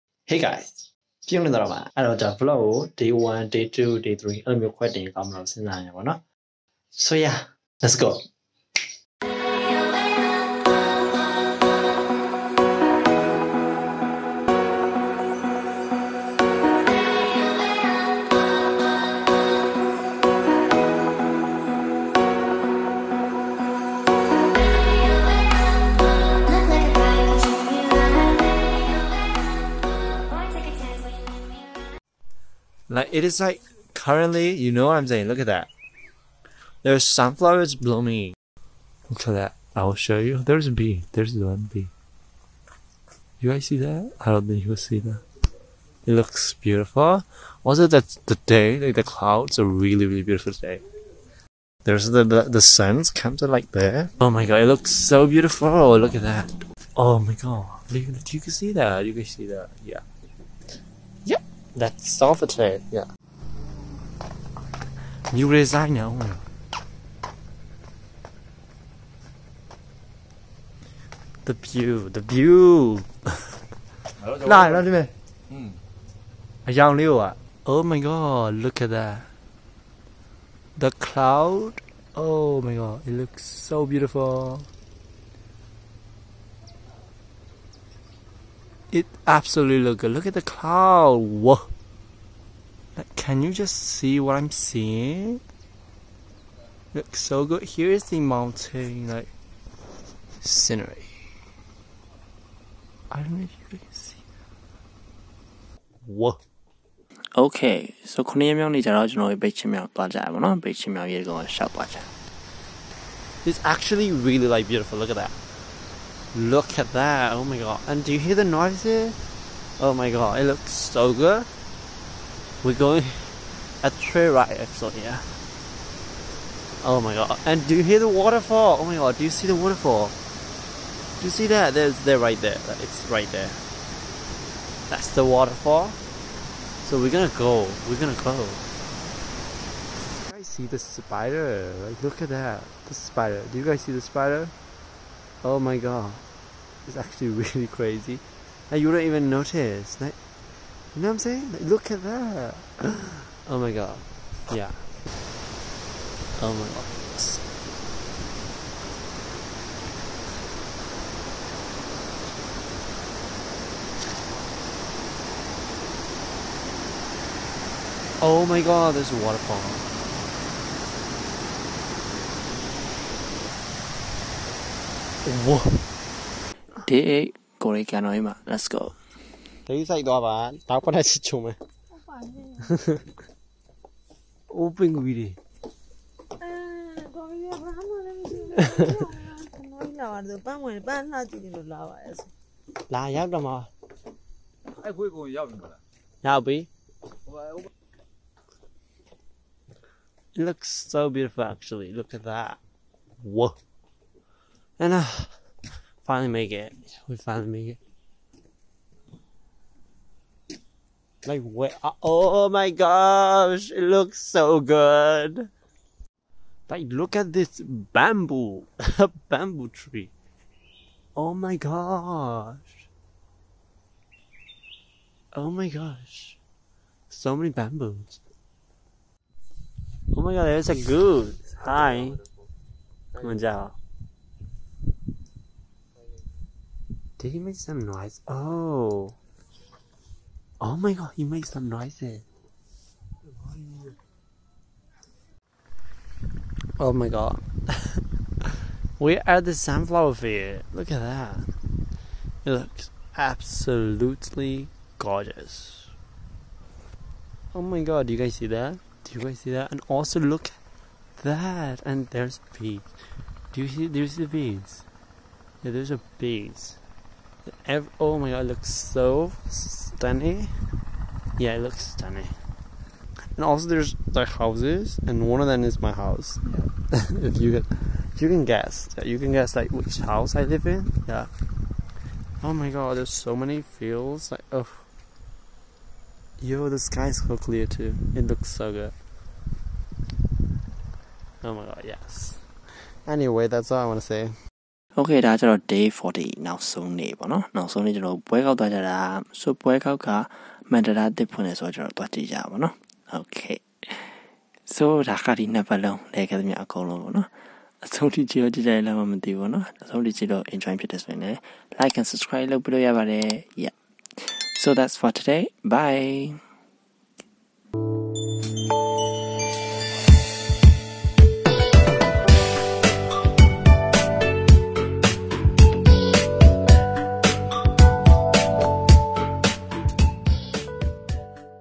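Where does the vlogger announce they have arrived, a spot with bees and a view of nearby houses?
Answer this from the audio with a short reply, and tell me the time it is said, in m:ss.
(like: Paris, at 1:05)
sunflower field, at 4:09.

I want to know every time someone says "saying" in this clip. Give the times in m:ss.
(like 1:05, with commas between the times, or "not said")
0:35, 2:31.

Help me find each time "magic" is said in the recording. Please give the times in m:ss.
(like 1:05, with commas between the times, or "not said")
not said.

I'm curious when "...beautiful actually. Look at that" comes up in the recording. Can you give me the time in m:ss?
3:21.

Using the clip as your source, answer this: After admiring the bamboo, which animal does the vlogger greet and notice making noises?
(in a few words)
goose.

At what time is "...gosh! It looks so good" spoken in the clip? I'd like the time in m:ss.
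3:32.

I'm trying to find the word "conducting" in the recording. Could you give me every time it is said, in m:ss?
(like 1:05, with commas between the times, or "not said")
not said.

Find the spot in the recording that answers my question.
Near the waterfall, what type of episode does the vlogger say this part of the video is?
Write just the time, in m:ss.
2:03.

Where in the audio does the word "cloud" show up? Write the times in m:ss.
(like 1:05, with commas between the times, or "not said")
0:49, 1:20, 1:30.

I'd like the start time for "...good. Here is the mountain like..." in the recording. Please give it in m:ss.
1:37.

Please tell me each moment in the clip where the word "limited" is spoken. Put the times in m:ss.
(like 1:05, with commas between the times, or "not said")
not said.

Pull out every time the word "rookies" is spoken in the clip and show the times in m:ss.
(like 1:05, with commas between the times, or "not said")
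not said.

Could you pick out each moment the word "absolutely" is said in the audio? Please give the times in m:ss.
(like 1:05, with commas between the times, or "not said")
1:29, 4:13.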